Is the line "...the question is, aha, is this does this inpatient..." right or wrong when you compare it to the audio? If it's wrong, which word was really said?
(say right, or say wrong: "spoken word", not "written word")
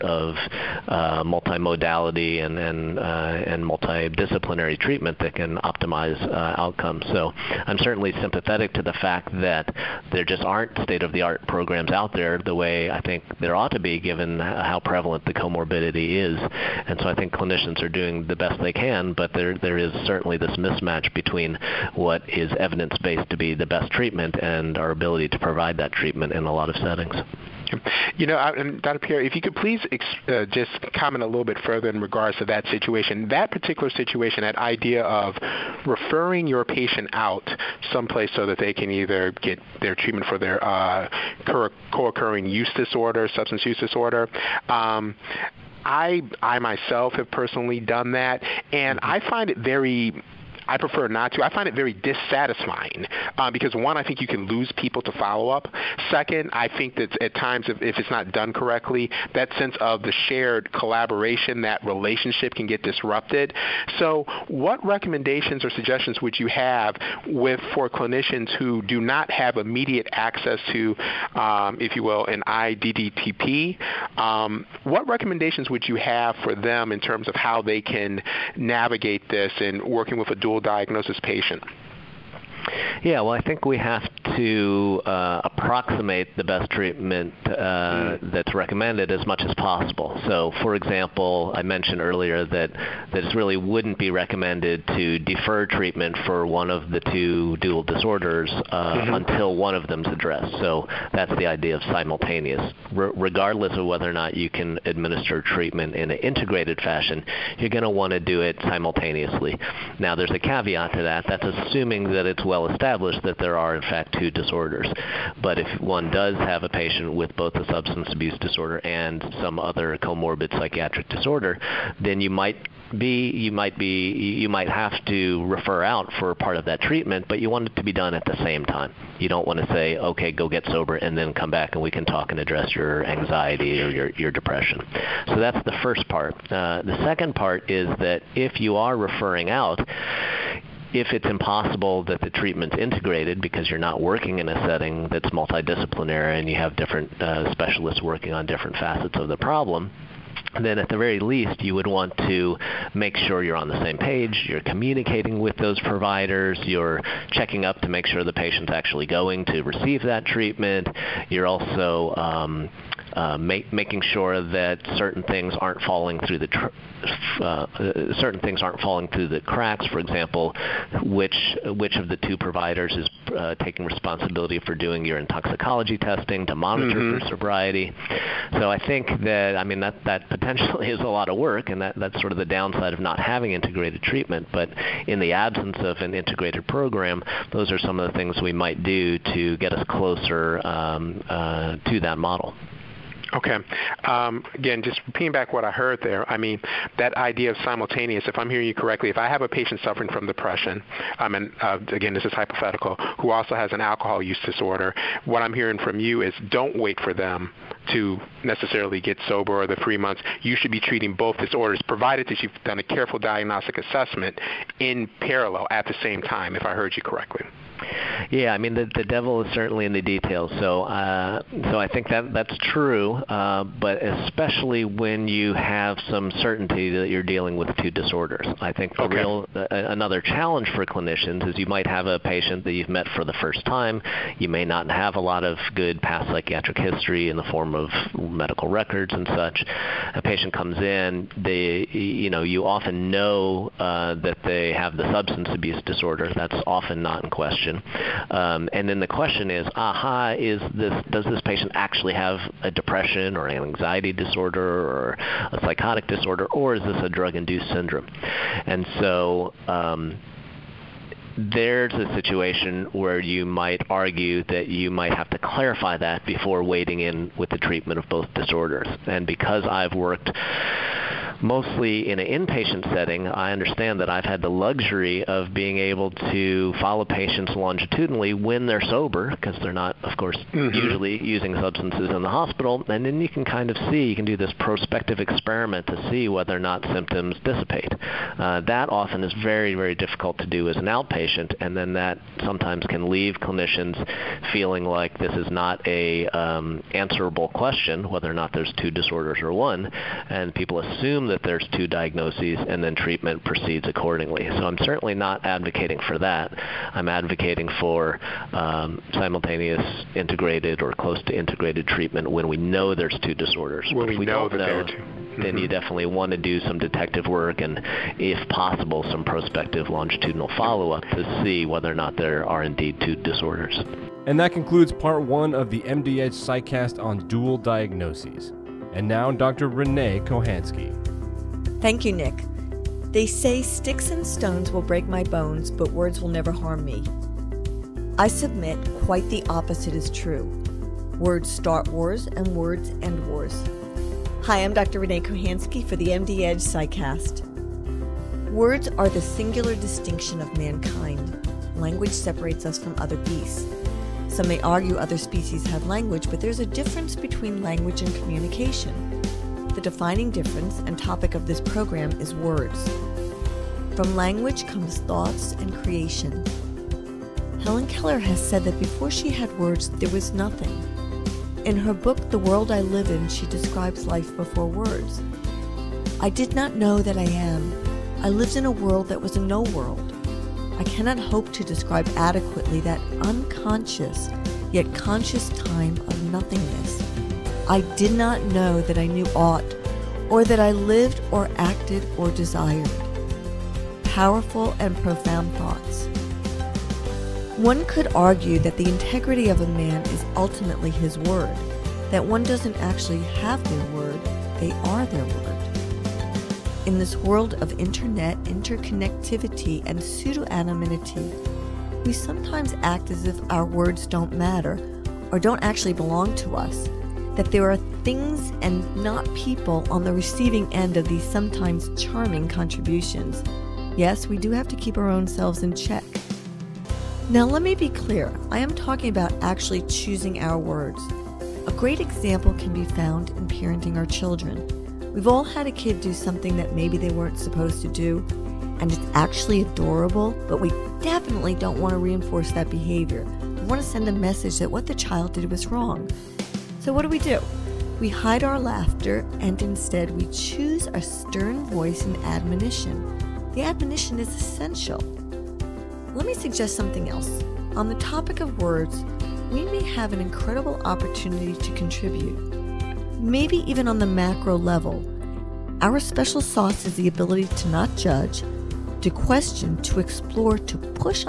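wrong: "patient", not "inpatient".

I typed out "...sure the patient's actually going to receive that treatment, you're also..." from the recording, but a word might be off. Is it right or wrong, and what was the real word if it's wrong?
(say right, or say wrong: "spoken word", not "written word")
right.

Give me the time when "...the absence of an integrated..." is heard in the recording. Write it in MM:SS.
03:05.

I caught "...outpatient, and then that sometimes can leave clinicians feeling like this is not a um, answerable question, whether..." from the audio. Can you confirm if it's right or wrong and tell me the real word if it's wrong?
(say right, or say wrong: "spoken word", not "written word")
right.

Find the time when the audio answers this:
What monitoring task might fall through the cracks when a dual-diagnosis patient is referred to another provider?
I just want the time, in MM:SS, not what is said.
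02:55.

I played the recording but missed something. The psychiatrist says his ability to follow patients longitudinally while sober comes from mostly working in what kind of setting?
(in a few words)
inpatient setting.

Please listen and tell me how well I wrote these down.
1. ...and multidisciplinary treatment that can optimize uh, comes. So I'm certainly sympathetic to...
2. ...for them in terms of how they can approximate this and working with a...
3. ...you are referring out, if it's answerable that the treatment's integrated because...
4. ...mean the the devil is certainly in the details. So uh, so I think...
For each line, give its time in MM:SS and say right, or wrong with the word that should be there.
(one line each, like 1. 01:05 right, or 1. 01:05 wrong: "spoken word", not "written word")
1. 00:03 wrong: "outcomes", not "comes"
2. 01:16 wrong: "navigate", not "approximate"
3. 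02:18 wrong: "impossible", not "answerable"
4. 03:38 right.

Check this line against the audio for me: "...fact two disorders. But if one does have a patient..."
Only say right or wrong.
right.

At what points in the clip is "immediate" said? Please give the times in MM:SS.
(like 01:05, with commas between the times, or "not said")
01:09.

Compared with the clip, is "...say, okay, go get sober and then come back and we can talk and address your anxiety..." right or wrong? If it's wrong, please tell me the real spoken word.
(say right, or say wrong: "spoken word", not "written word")
right.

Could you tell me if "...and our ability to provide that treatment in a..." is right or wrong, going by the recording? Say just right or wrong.
right.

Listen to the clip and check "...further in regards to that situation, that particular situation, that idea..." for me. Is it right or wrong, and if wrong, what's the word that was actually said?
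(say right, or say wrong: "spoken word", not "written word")
right.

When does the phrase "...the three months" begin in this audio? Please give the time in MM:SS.
03:29.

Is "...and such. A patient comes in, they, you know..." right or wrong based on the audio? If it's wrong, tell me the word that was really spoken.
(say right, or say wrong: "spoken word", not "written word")
right.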